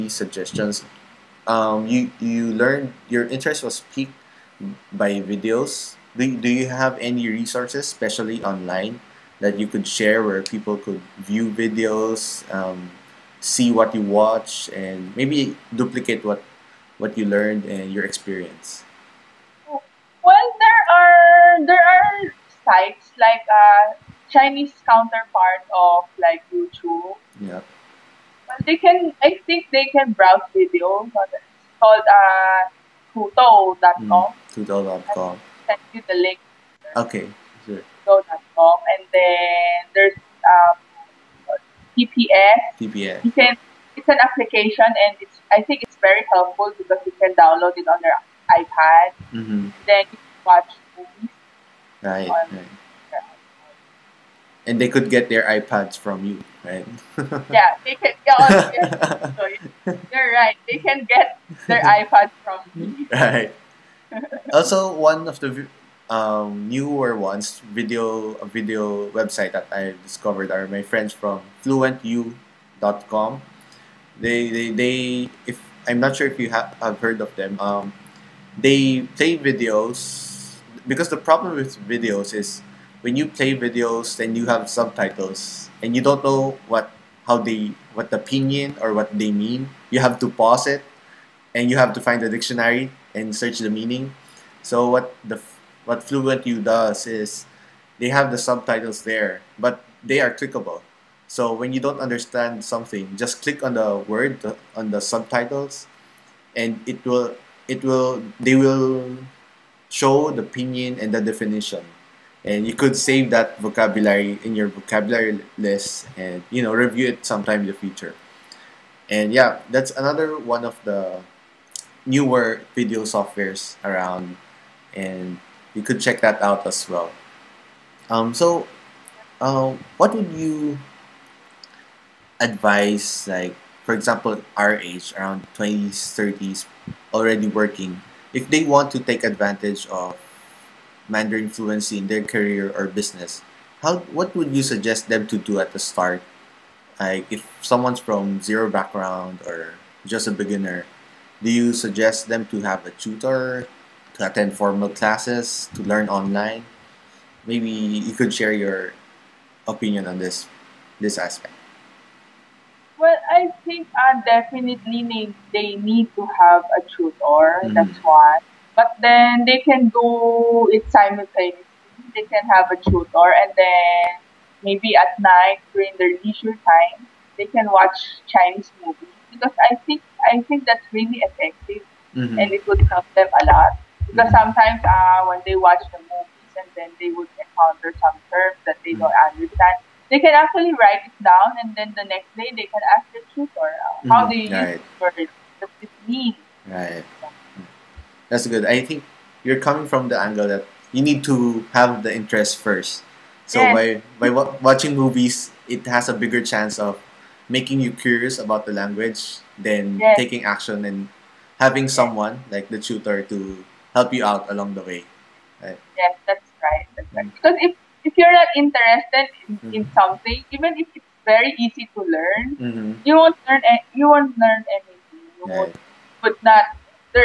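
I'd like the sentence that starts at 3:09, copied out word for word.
don't understand they can actually write it down and then the next day they can ask the tutor uh, how mm-hmm.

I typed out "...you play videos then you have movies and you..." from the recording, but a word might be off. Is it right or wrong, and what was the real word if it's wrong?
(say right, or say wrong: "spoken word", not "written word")
wrong: "subtitles", not "movies".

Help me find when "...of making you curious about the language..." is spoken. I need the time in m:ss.
3:26.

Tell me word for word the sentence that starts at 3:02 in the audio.
and it would help them a lot because mm-hmm.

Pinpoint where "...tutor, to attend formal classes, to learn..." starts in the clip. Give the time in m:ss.
2:32.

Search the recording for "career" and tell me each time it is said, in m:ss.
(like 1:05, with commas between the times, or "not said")
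2:22.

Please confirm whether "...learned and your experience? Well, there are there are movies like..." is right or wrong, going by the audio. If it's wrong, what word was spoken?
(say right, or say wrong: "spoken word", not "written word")
wrong: "sites", not "movies".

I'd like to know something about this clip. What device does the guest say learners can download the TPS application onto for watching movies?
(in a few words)
iPad.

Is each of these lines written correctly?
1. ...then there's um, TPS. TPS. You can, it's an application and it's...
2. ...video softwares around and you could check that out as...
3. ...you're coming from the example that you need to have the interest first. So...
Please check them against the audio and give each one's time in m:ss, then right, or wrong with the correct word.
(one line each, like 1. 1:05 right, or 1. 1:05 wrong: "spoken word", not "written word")
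1. 0:39 right
2. 2:02 right
3. 3:19 wrong: "angle", not "example".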